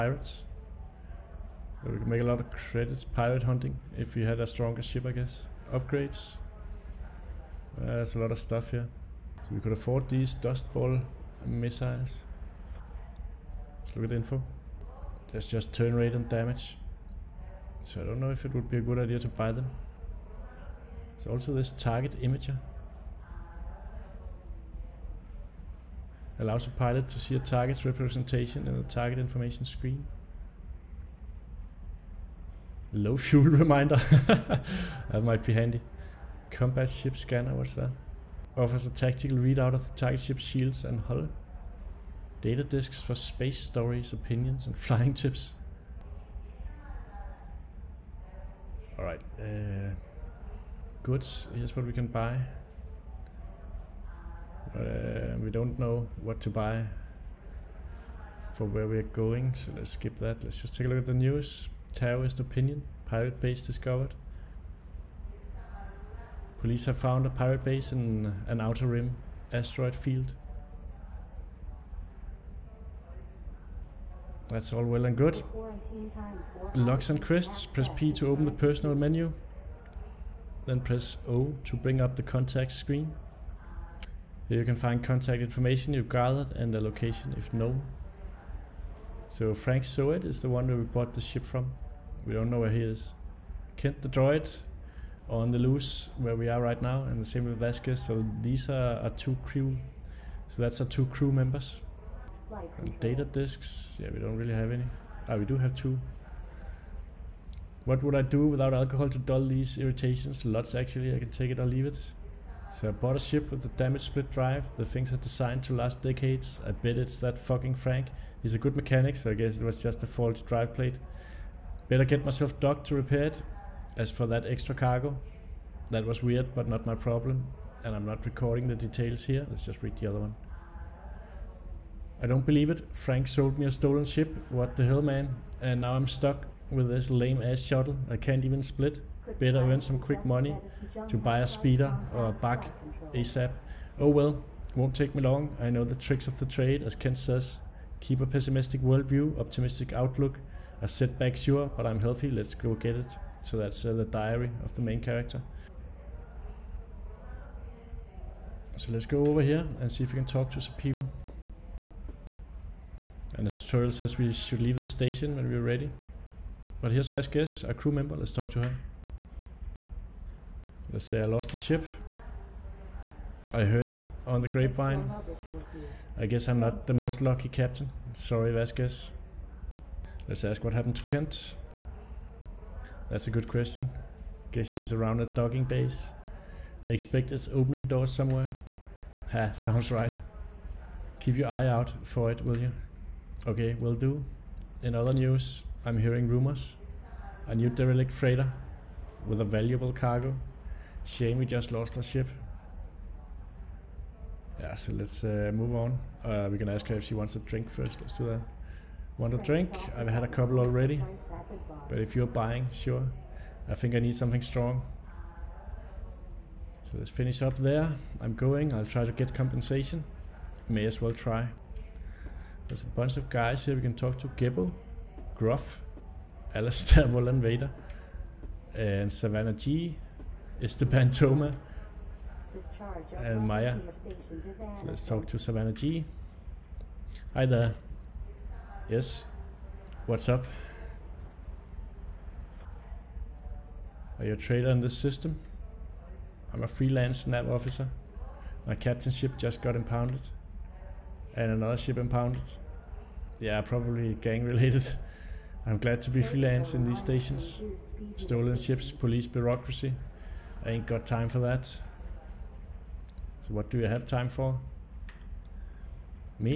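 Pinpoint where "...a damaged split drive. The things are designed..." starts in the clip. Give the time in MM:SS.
01:53.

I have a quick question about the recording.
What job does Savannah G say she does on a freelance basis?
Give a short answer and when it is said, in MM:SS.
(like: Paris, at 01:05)
NAV officer, at 04:07.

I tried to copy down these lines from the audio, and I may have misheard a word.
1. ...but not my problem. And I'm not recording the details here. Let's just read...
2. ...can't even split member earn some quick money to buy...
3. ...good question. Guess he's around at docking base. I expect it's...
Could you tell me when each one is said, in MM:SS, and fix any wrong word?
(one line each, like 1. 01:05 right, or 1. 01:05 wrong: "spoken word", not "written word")
1. 02:06 right
2. 02:18 wrong: "better", not "member"
3. 03:03 right.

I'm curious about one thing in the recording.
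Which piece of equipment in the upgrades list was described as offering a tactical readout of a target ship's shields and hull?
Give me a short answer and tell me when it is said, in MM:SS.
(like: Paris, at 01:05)
Combat ship scanner, at 00:36.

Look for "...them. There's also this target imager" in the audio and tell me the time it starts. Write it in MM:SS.
00:19.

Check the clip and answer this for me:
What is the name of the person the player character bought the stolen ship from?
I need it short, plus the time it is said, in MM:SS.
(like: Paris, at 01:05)
Frank Seward, at 01:29.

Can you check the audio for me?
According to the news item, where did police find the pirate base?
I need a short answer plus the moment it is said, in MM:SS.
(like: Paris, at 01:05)
An outer rim asteroid field, at 01:08.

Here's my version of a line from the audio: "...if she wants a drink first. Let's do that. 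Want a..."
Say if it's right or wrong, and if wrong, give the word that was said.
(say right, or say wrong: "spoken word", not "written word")
right.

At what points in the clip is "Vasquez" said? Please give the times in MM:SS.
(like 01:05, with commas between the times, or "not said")
01:37, 02:47, 02:58.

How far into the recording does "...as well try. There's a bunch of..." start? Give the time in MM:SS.
03:40.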